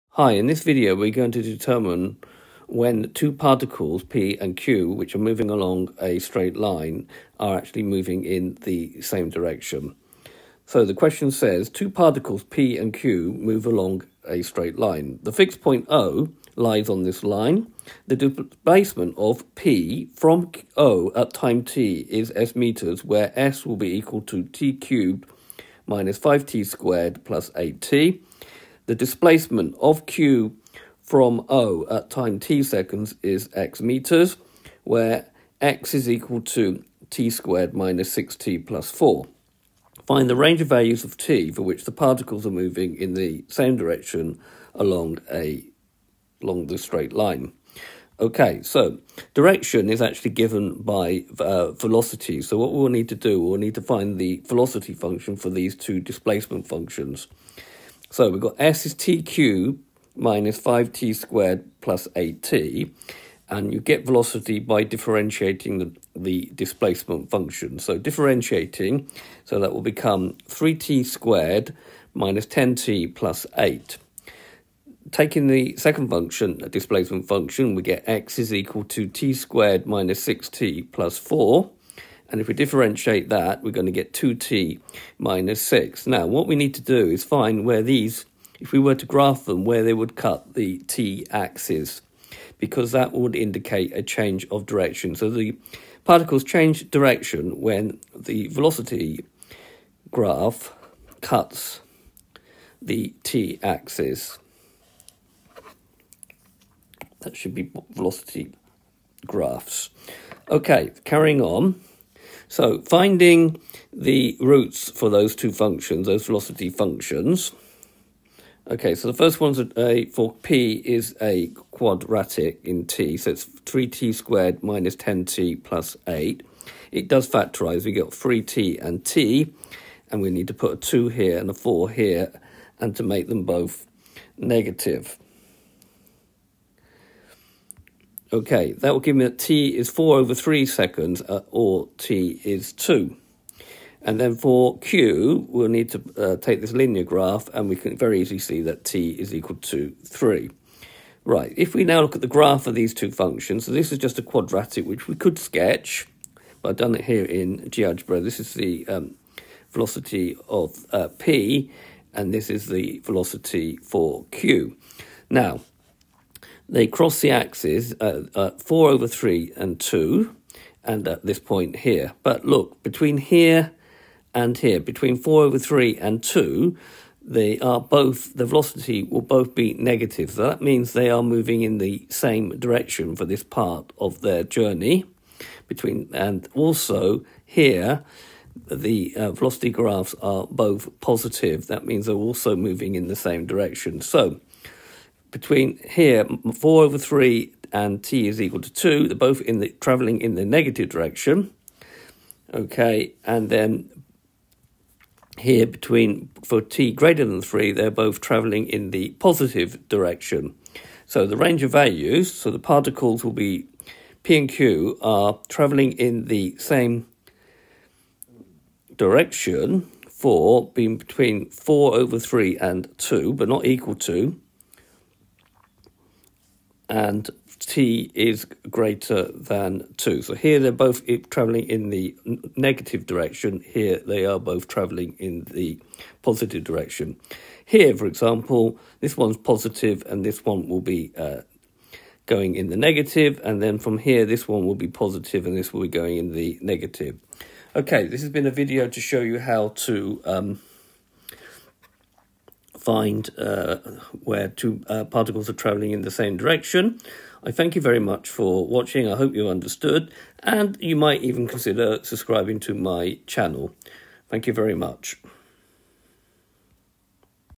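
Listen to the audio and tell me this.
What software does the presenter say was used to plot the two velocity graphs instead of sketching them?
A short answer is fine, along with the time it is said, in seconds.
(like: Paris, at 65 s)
GeoGebra, at 157 s.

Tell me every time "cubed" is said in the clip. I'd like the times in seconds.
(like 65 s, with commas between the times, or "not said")
24 s, 59 s.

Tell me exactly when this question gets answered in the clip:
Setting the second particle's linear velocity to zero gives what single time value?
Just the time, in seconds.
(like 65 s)
148 s.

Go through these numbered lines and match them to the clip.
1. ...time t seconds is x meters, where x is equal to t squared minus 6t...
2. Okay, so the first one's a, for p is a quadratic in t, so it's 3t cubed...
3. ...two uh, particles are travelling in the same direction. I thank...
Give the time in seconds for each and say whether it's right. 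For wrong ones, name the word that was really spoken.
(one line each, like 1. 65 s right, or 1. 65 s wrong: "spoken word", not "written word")
1. 32 s right
2. 118 s wrong: "squared", not "cubed"
3. 254 s right.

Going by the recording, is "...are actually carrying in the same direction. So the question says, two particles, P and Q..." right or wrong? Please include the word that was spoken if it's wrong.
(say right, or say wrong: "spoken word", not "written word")
wrong: "moving", not "carrying".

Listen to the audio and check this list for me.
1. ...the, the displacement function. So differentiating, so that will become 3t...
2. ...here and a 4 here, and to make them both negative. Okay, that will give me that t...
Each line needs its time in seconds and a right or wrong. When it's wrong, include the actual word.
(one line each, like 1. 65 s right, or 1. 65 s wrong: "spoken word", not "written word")
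1. 65 s right
2. 131 s right.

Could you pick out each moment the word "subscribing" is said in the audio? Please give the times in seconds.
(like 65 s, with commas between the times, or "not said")
262 s.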